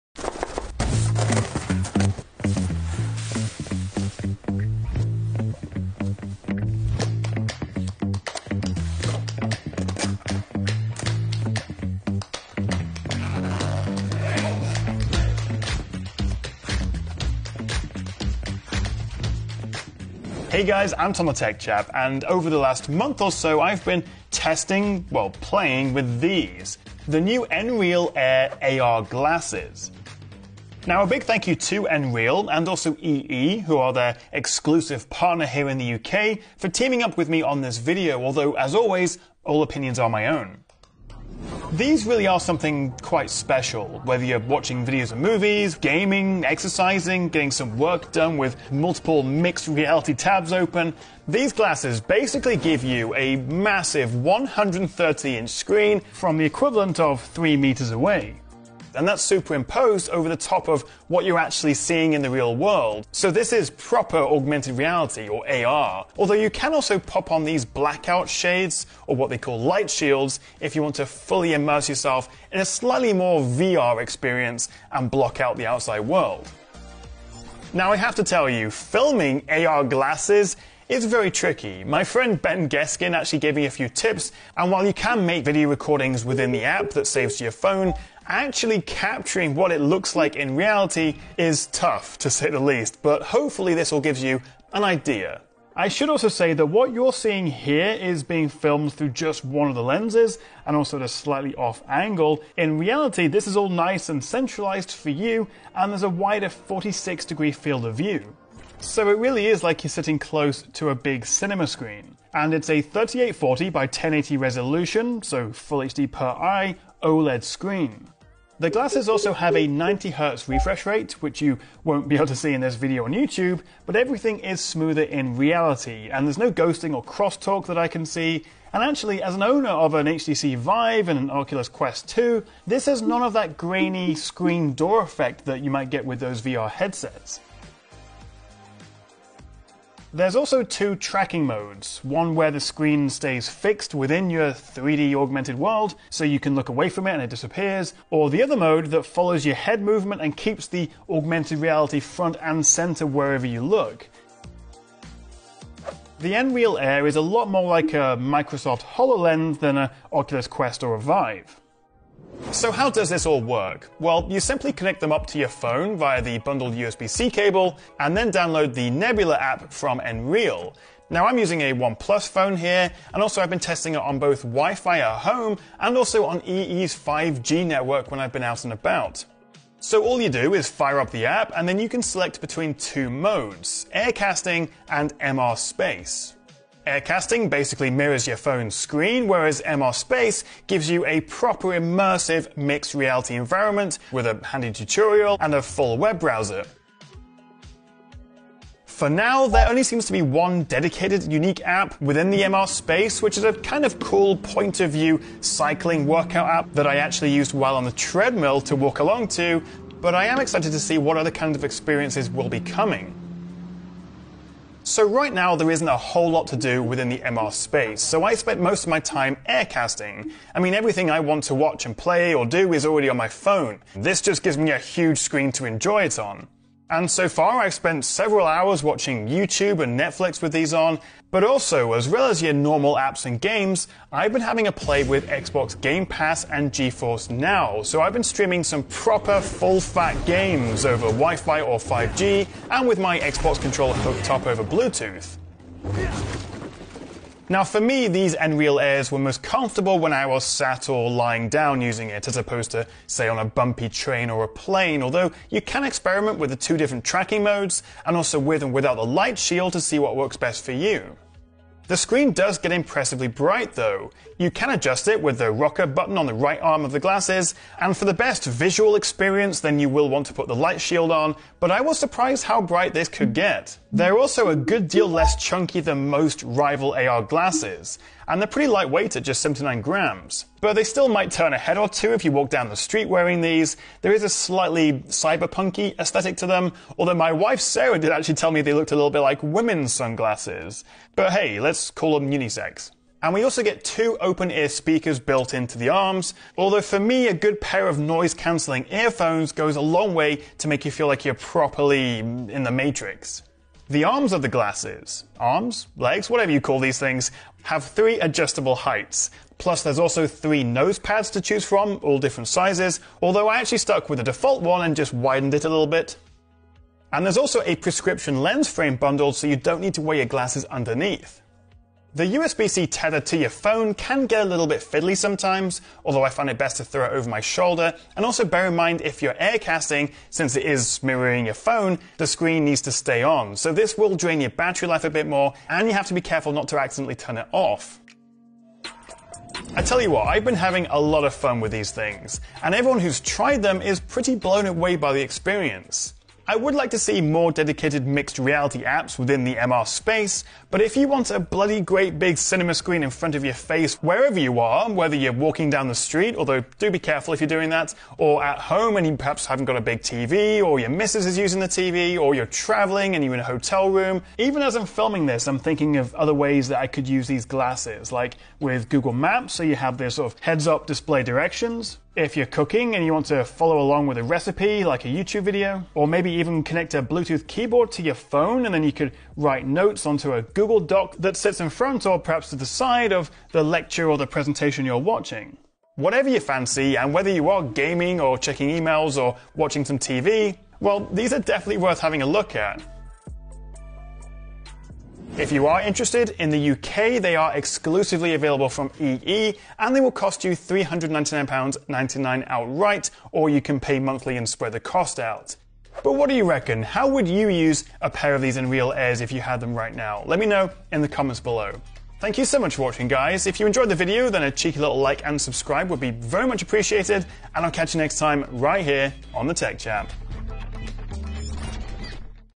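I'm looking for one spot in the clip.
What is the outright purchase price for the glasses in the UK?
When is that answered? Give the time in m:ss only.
6:40.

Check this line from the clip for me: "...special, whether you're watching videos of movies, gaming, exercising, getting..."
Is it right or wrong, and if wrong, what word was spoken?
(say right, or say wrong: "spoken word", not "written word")
right.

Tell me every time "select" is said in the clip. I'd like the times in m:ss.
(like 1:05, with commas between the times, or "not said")
3:02.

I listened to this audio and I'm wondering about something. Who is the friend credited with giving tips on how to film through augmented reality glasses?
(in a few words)
Ben Geskin.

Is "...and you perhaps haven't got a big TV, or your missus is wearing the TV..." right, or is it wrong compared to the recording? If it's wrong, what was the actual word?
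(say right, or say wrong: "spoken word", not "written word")
wrong: "using", not "wearing".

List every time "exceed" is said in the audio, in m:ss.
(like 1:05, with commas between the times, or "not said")
not said.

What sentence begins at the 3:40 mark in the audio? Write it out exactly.
I mean everything I want to watch and play or do is already on my phone.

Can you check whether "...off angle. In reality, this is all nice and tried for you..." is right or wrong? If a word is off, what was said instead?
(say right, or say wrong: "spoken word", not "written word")
wrong: "centralized", not "tried".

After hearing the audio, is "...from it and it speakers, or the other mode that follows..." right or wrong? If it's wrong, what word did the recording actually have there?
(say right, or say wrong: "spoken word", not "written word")
wrong: "disappears", not "speakers".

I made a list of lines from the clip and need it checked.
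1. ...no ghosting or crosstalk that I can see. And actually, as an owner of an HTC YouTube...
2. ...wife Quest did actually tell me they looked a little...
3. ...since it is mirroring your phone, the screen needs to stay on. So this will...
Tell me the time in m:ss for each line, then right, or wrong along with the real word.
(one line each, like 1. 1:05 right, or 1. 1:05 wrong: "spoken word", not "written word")
1. 2:06 wrong: "Vive", not "YouTube"
2. 4:47 wrong: "Sarah", not "Quest"
3. 5:30 right.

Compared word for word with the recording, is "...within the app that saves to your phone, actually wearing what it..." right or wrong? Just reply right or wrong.
wrong.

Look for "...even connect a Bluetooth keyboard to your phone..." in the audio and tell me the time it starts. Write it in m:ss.
6:16.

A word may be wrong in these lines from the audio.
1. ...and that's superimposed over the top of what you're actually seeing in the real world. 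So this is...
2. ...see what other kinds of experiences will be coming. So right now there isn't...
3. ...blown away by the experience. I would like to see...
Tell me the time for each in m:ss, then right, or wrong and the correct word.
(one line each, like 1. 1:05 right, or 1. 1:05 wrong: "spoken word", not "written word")
1. 0:58 right
2. 3:30 right
3. 5:44 right.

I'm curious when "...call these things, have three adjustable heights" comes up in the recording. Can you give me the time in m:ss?
5:06.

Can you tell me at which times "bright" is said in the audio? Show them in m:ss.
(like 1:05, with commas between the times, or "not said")
4:23, 4:32.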